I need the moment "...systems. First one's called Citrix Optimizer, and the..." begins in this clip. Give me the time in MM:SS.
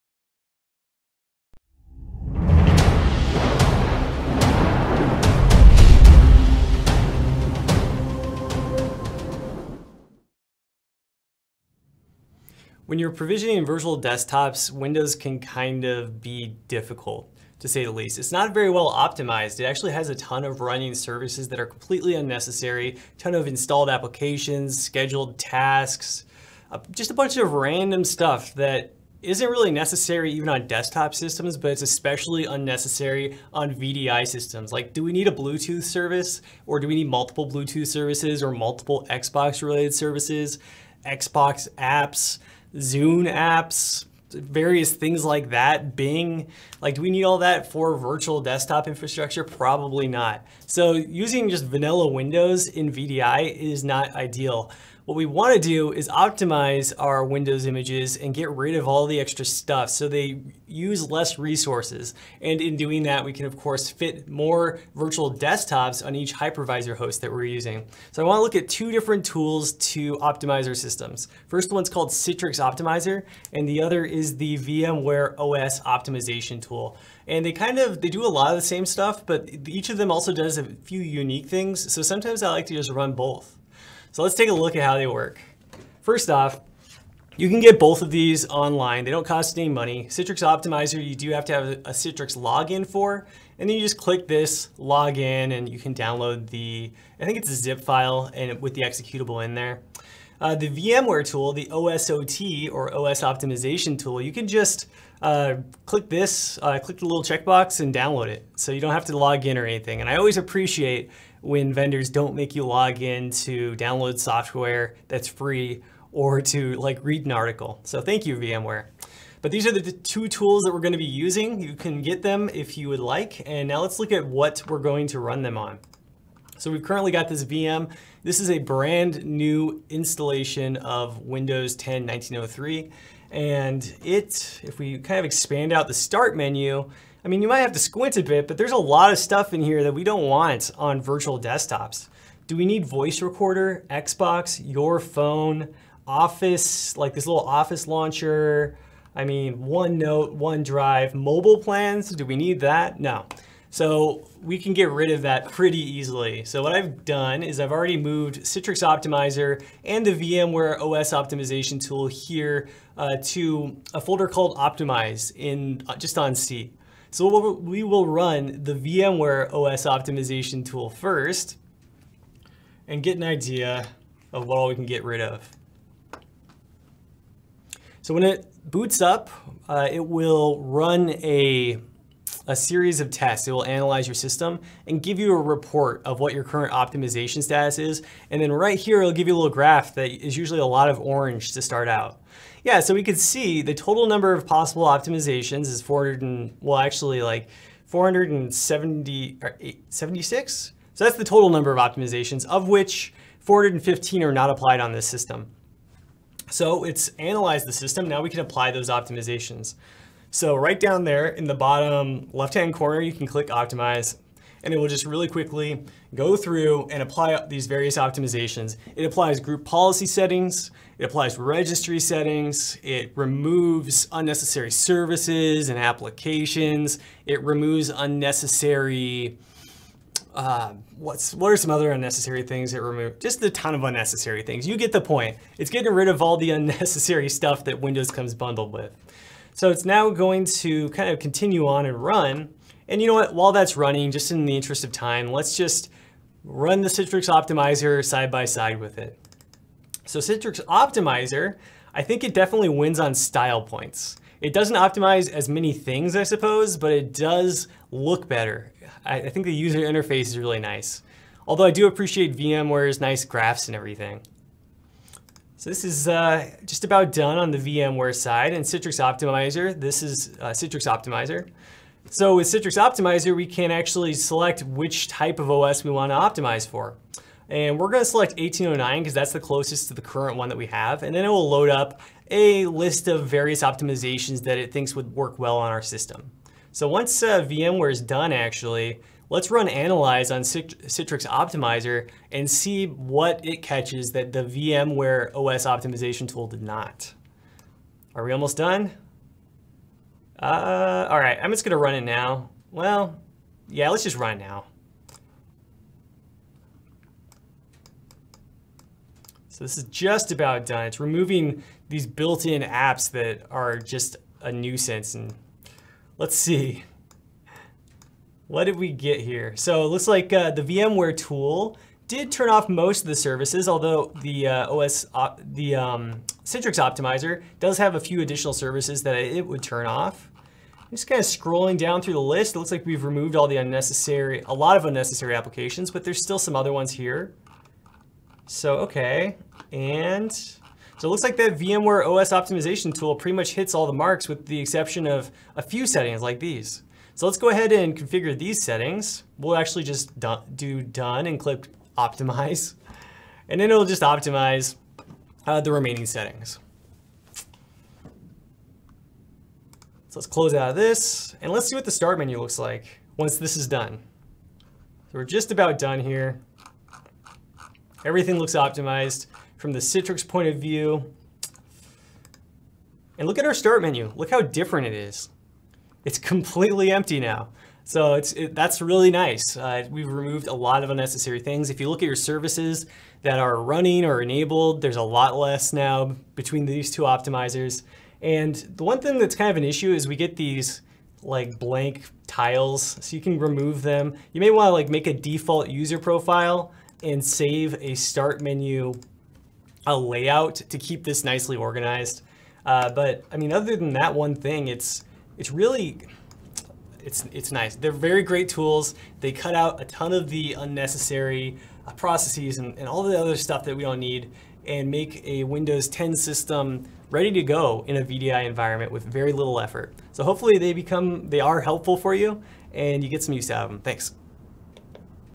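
01:10.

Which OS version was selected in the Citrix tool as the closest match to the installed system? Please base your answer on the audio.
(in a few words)
1809.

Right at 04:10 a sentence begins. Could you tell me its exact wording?
So Citrix Optimizer, I think it definitely wins on style points.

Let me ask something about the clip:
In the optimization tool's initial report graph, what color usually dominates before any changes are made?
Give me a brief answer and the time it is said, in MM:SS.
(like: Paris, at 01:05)
Orange, at 03:10.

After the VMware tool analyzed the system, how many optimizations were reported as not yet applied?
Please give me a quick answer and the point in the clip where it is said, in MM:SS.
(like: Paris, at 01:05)
415, at 03:23.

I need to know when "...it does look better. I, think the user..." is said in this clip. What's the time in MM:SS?
04:16.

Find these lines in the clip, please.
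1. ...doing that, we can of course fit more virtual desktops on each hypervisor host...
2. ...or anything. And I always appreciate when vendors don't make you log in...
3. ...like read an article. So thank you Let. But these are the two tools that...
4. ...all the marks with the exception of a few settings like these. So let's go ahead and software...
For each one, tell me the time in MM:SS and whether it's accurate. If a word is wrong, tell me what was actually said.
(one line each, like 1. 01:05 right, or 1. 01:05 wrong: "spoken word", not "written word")
1. 01:02 right
2. 01:49 right
3. 01:56 wrong: "VMware", not "Let"
4. 05:43 wrong: "configure", not "software".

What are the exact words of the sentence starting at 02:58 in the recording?
So when it boots up, uh, it will run a a series of tests.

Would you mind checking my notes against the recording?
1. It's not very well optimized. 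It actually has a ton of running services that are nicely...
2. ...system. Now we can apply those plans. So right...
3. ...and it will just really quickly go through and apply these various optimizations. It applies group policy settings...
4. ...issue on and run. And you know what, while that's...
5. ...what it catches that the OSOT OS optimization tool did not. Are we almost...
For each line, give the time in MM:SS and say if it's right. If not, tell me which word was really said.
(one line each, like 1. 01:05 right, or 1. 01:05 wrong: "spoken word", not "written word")
1. 00:18 wrong: "completely", not "nicely"
2. 03:27 wrong: "optimizations", not "plans"
3. 03:34 right
4. 04:01 wrong: "continue", not "issue"
5. 04:52 wrong: "VMware", not "OSOT".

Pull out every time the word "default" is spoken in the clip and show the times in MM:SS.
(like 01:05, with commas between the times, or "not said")
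06:35.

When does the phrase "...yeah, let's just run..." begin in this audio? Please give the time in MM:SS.
05:03.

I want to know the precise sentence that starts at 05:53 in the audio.
And then it'll just optimize uh, the remaining settings.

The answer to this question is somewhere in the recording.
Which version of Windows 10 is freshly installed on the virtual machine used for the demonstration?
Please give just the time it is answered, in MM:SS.
02:12.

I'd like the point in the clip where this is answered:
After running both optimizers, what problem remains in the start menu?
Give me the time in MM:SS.
06:31.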